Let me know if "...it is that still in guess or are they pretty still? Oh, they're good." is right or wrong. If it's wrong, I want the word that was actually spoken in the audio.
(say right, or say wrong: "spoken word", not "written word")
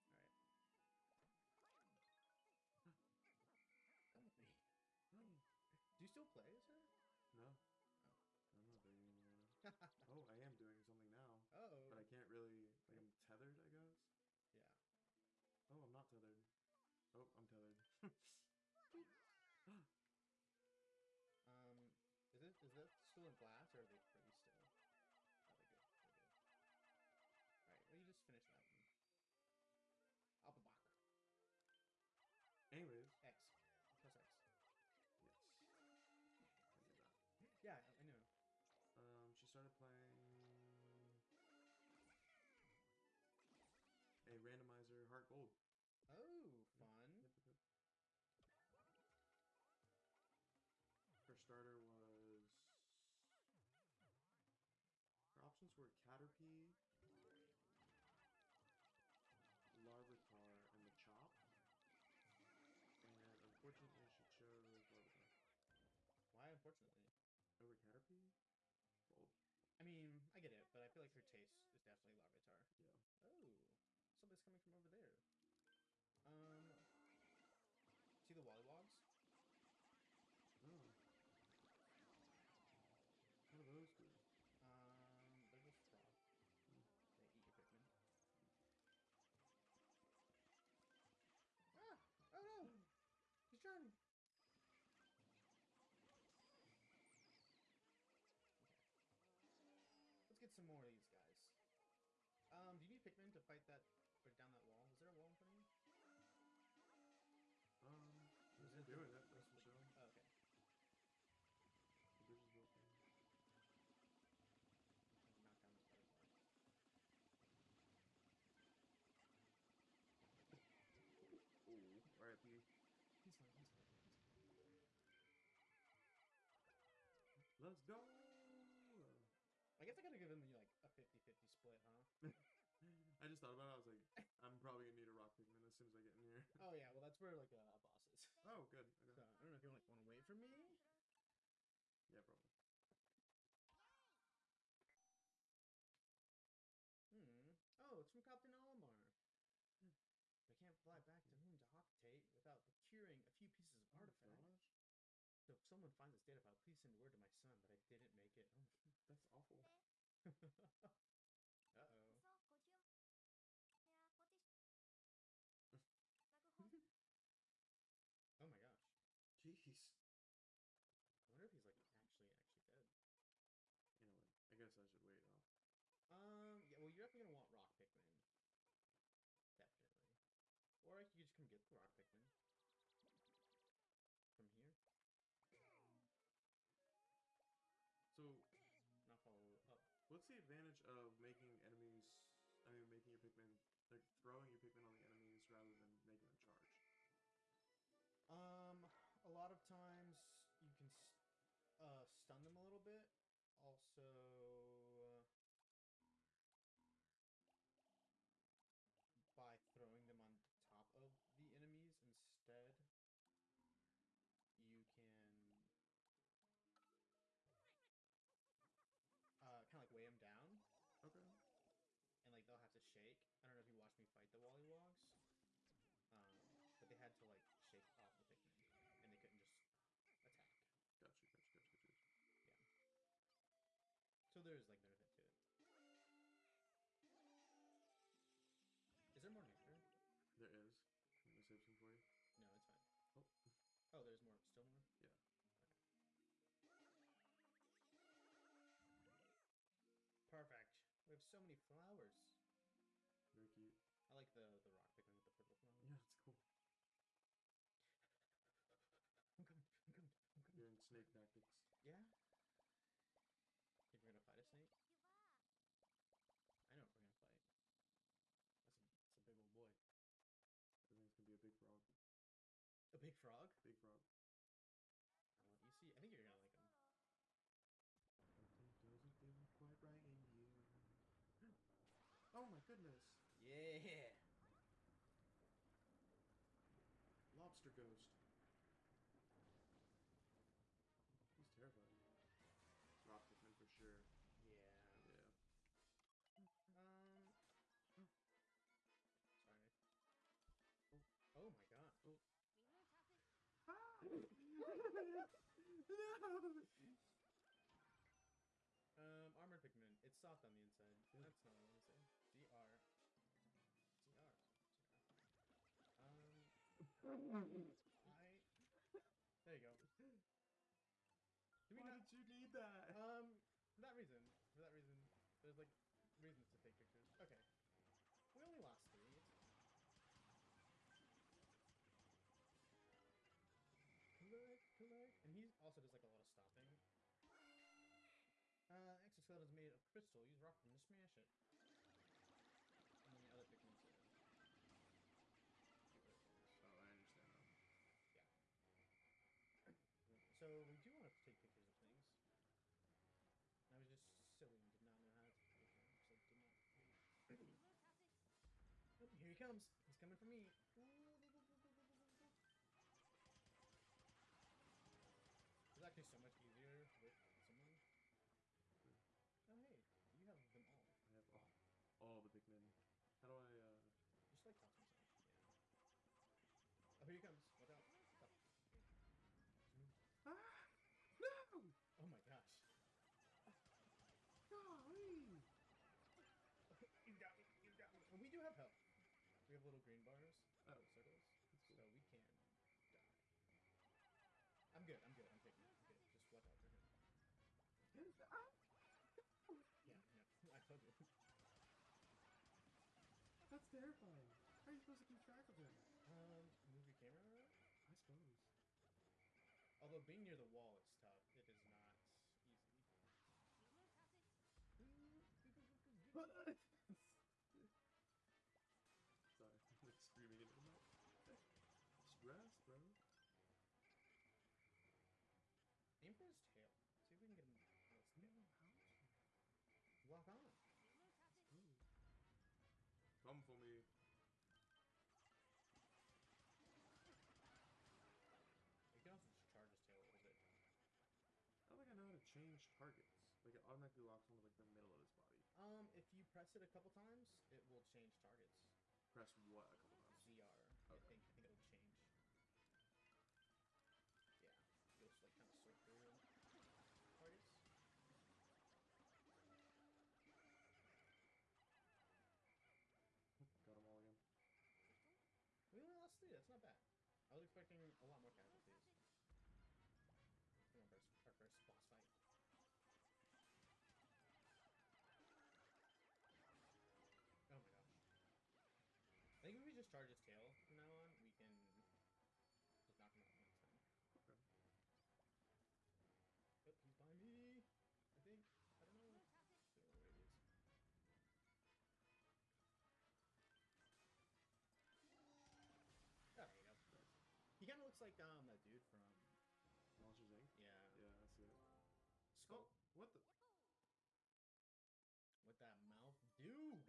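wrong: "glass", not "guess".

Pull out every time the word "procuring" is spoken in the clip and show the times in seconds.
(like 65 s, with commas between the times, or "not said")
152 s.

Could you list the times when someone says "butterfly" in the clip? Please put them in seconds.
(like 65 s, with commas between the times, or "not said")
122 s.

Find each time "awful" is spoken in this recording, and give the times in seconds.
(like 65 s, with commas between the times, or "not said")
159 s.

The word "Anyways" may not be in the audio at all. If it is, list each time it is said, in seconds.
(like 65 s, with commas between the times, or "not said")
32 s, 174 s.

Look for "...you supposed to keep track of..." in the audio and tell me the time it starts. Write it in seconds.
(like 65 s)
404 s.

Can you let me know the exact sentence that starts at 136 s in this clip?
Oh yeah, well that's where like uh, a, boss is.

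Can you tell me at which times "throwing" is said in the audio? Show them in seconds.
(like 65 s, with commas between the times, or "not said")
194 s, 209 s.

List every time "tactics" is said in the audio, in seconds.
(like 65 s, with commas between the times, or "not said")
261 s.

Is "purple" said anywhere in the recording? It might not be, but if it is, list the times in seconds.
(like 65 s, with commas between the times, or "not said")
255 s.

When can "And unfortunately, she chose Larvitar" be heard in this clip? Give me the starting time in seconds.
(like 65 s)
63 s.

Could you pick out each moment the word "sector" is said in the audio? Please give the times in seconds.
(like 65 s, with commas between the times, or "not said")
not said.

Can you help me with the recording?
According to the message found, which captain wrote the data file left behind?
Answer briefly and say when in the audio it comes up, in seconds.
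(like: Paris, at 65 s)
Captain Olimar, at 148 s.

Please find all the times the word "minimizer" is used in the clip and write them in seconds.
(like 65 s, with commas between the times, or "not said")
not said.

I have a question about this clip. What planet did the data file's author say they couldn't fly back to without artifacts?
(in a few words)
Hocotate.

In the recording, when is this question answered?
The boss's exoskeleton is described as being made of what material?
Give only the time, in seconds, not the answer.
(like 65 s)
339 s.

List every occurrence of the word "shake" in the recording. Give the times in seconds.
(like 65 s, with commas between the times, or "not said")
222 s, 227 s.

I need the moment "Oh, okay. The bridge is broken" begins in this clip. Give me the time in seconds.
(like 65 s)
109 s.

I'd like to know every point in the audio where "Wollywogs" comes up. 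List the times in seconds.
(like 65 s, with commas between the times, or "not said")
78 s, 224 s.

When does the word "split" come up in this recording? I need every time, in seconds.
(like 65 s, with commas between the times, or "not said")
131 s.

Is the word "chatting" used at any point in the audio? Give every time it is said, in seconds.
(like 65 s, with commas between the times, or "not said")
not said.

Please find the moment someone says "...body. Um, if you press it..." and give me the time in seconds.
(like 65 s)
445 s.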